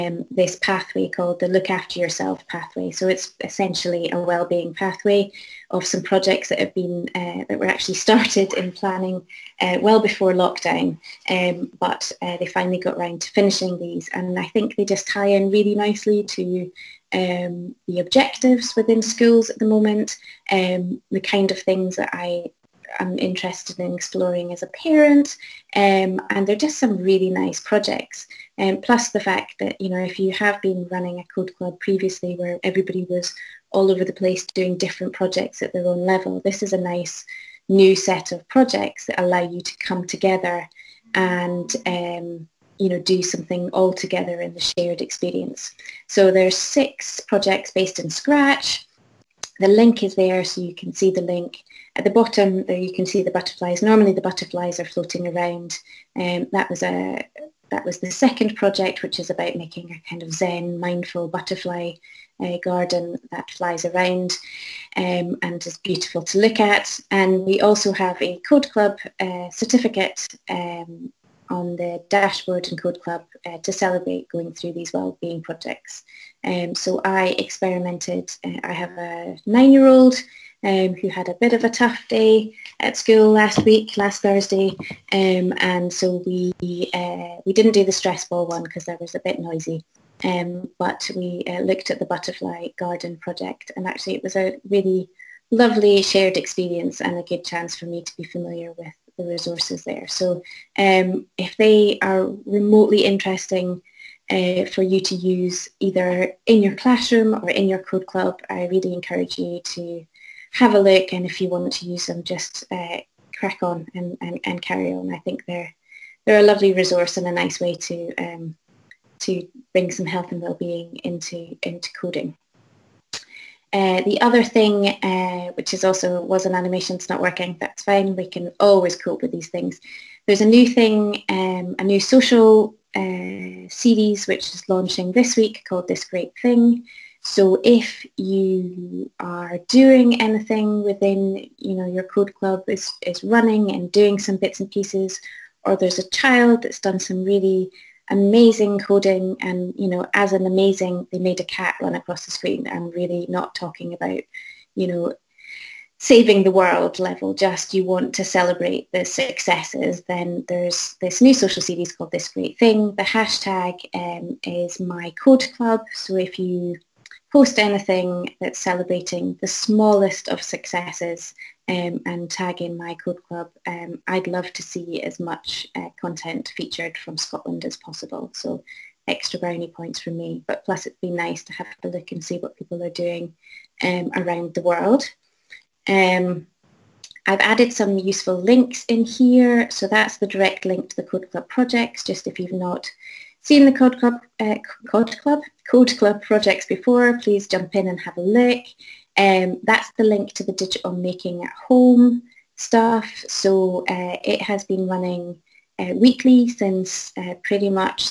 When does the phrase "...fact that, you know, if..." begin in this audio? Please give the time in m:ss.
0:29.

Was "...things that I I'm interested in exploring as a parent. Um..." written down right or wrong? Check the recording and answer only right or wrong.
right.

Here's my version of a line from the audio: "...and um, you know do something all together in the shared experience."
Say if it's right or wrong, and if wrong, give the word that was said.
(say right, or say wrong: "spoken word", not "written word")
right.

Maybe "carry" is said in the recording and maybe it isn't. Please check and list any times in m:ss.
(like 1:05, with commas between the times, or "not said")
1:54.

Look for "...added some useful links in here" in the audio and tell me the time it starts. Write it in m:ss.
3:07.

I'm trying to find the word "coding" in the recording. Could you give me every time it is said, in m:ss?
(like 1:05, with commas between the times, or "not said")
2:01, 2:28.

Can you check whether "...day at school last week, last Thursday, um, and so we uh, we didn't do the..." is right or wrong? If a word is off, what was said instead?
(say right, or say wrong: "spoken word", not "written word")
right.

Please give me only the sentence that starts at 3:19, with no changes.
Um, that's the link to the Digital Making at Home stuff.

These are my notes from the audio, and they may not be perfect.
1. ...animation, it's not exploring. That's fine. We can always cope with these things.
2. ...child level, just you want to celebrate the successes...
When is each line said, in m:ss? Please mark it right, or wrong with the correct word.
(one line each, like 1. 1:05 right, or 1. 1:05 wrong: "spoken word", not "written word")
1. 2:06 wrong: "working", not "exploring"
2. 2:36 wrong: "world", not "child".